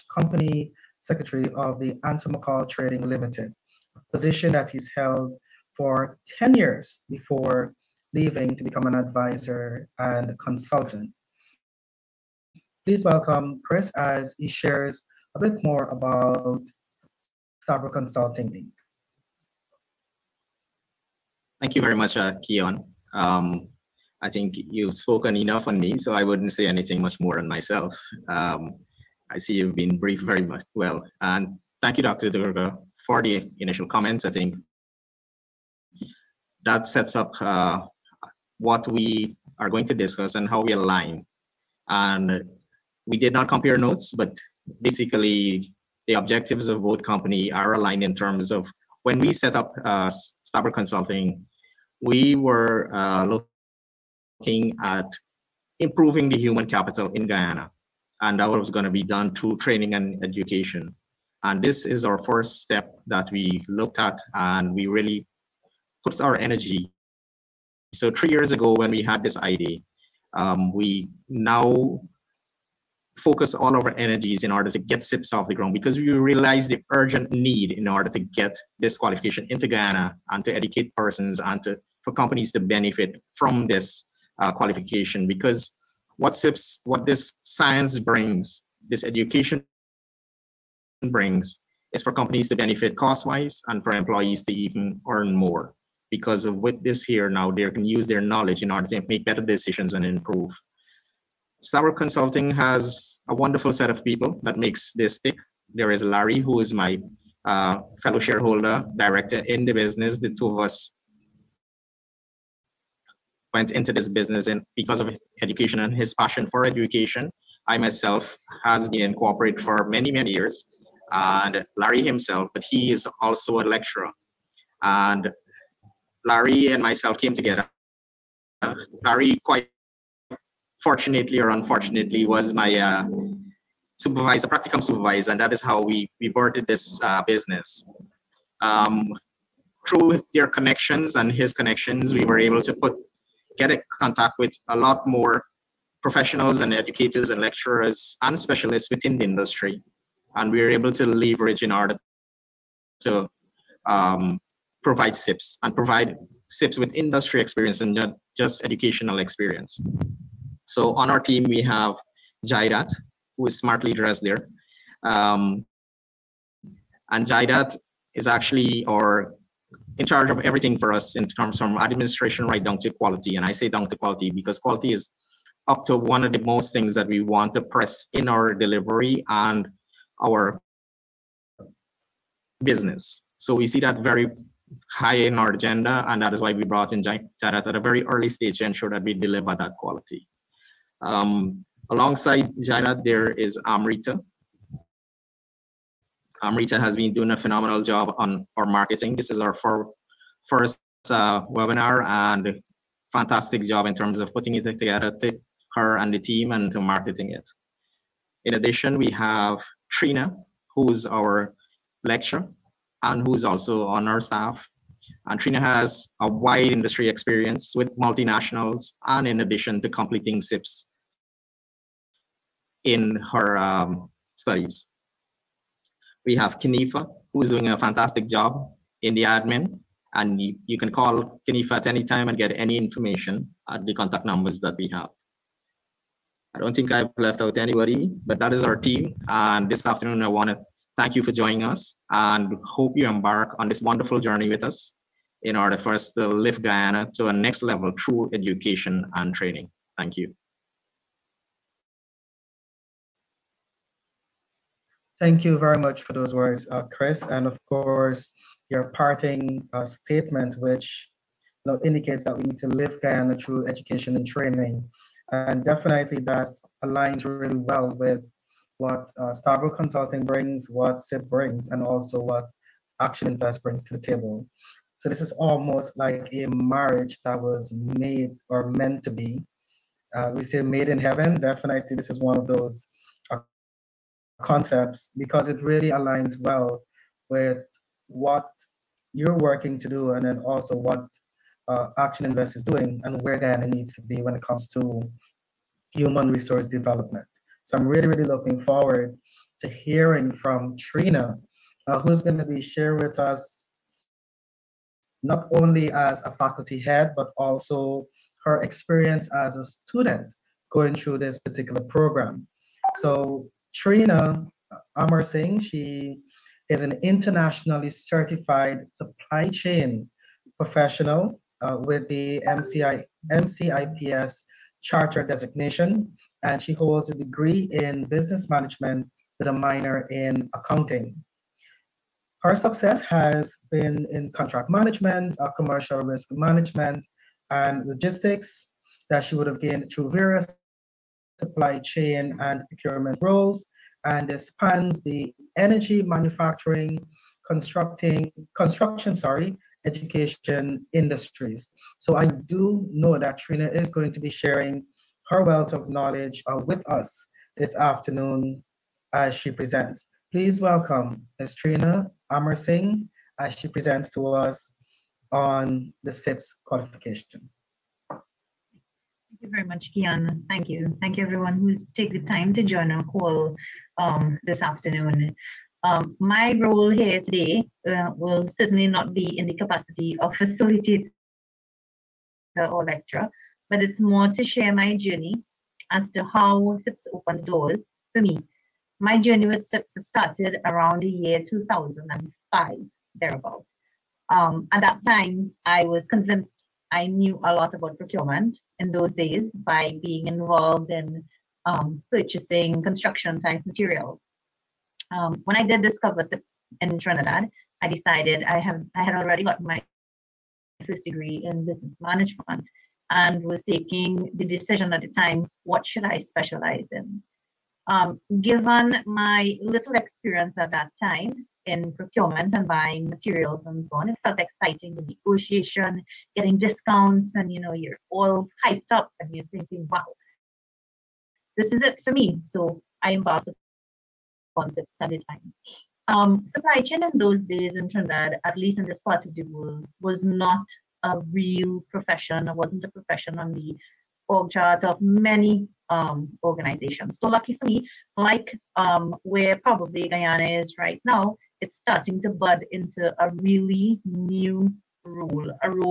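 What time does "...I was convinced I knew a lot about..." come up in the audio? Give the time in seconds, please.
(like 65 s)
395 s.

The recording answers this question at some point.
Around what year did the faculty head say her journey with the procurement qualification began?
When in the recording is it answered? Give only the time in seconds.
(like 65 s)
391 s.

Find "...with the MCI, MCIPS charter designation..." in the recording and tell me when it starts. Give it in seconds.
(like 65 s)
321 s.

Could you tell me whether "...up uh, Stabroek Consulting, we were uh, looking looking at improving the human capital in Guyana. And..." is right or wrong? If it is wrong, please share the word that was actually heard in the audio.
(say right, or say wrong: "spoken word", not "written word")
right.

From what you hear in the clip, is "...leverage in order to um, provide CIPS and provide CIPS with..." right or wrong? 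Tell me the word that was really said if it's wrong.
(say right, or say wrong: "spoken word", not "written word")
right.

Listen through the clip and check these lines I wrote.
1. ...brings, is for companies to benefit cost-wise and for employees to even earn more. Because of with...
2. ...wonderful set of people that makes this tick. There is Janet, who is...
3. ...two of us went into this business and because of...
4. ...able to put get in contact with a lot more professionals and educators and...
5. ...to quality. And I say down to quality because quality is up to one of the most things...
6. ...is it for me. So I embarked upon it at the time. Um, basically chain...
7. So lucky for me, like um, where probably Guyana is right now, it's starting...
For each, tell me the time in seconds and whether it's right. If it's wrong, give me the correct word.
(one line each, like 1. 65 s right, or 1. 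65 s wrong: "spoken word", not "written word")
1. 91 s right
2. 103 s wrong: "Larry", not "Janet"
3. 110 s right
4. 142 s right
5. 172 s right
6. 431 s wrong: "supply", not "basically"
7. 447 s right.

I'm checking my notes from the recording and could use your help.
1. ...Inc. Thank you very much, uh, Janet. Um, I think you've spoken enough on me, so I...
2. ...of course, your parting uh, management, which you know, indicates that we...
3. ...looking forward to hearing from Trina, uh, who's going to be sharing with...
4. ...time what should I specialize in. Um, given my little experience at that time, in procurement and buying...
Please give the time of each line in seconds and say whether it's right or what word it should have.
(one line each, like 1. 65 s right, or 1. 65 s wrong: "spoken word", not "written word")
1. 18 s wrong: "Keon", not "Janet"
2. 257 s wrong: "statement", not "management"
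3. 298 s right
4. 415 s right.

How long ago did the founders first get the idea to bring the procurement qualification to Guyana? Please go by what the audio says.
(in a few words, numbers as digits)
3 years.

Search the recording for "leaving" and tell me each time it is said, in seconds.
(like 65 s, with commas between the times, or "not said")
8 s.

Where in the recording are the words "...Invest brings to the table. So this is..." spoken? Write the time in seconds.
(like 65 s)
273 s.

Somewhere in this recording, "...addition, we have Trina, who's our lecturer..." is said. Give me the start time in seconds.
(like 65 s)
208 s.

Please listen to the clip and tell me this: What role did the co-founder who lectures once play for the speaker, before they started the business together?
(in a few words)
Practicum supervisor.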